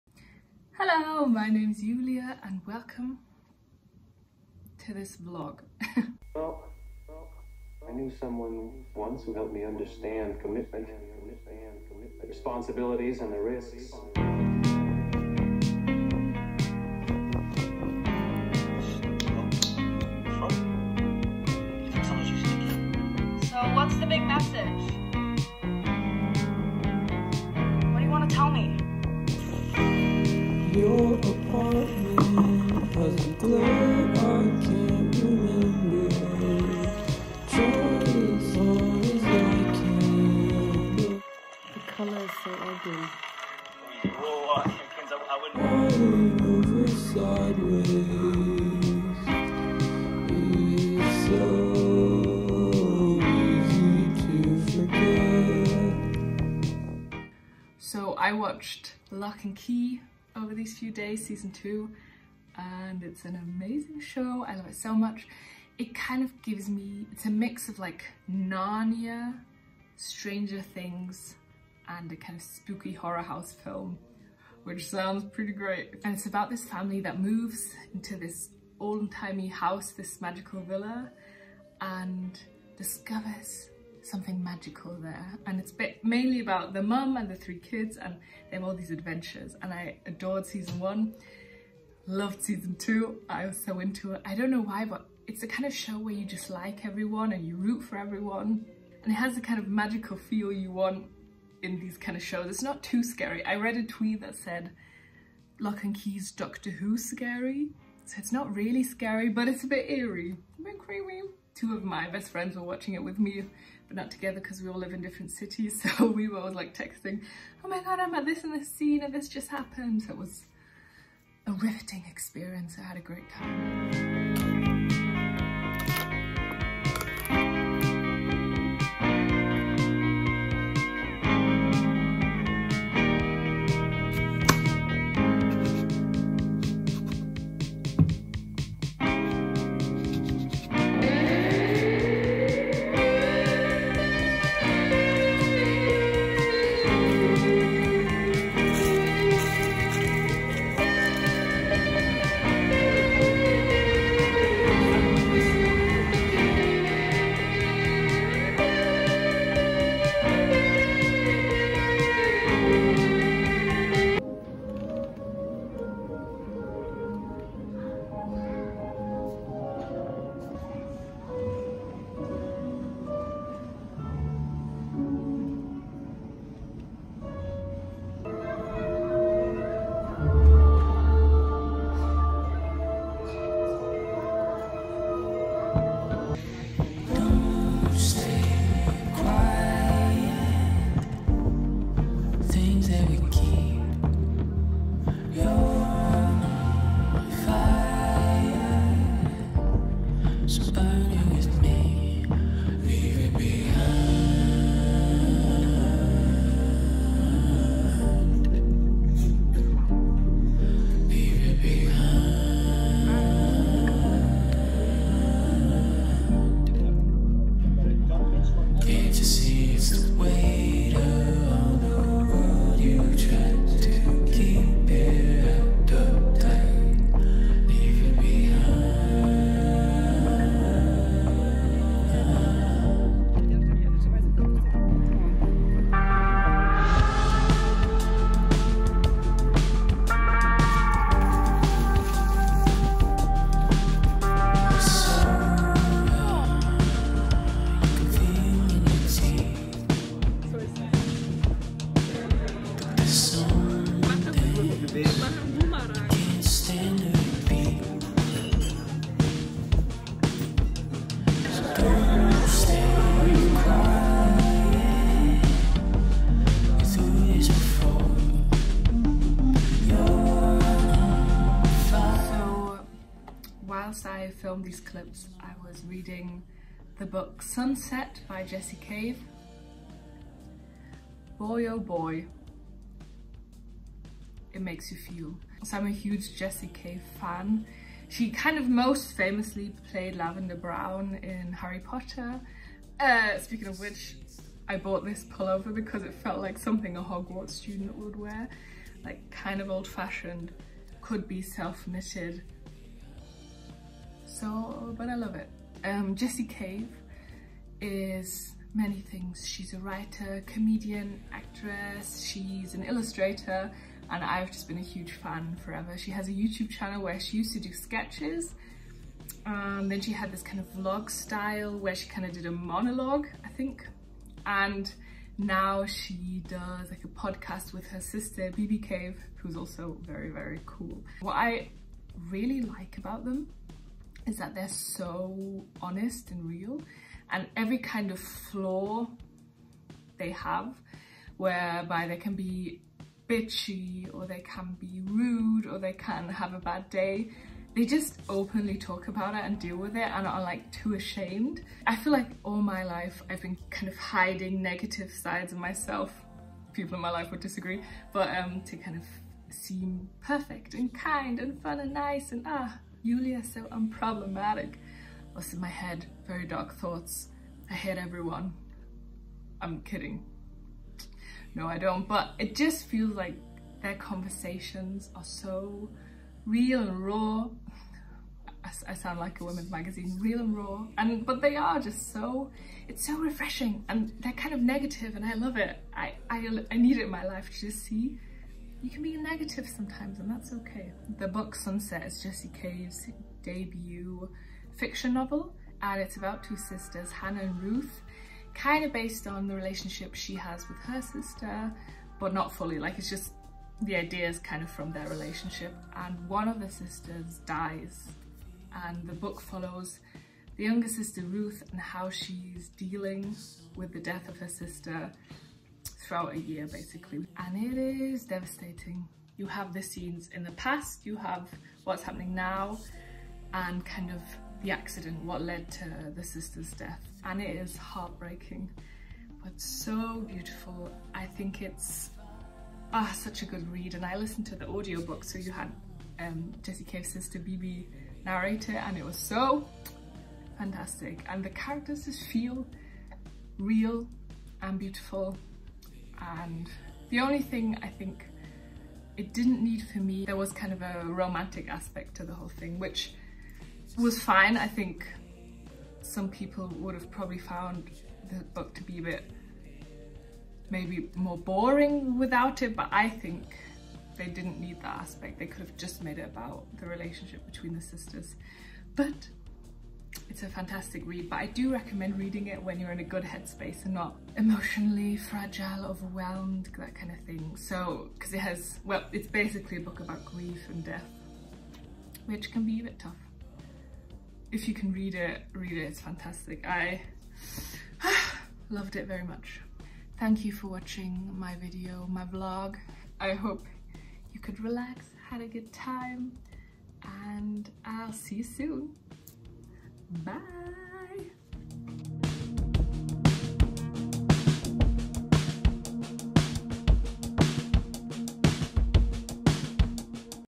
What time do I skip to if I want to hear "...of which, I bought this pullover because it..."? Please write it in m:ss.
4:53.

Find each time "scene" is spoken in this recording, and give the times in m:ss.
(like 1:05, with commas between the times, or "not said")
1:58, 6:59.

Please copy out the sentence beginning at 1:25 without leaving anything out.
And it's mainly about the mum and the three kids, and they have all these adventures.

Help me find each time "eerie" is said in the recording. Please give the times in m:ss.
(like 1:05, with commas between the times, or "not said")
1:49.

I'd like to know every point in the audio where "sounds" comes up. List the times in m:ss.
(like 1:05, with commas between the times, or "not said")
1:14, 6:18.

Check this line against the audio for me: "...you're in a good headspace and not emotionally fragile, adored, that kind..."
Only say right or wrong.
wrong.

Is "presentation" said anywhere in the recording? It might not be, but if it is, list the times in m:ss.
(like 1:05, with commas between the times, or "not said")
not said.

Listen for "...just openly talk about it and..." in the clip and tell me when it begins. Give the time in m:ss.
5:47.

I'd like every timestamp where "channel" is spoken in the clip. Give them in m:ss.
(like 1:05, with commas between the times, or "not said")
5:16.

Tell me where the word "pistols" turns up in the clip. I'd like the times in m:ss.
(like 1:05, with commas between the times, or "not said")
not said.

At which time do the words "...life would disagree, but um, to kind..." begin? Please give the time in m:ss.
5:57.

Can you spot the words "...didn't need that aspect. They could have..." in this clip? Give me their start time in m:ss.
7:44.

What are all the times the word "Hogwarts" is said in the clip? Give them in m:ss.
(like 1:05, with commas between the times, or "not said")
4:57.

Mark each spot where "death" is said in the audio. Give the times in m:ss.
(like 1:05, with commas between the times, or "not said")
6:53, 7:06, 8:00.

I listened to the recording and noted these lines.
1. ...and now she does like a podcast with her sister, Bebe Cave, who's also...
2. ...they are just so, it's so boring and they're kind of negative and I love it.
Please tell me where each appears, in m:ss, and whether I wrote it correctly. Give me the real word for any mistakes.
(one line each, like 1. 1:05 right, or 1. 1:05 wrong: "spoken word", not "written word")
1. 5:24 right
2. 6:21 wrong: "refreshing", not "boring".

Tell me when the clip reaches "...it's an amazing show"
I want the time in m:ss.
1:03.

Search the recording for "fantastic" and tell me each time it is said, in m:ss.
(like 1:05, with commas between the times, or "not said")
7:20, 7:50, 8:06.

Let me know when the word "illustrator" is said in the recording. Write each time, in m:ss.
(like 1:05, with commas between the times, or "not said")
5:12.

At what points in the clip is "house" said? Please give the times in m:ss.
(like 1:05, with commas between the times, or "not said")
1:13, 1:19.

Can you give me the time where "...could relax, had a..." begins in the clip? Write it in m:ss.
8:14.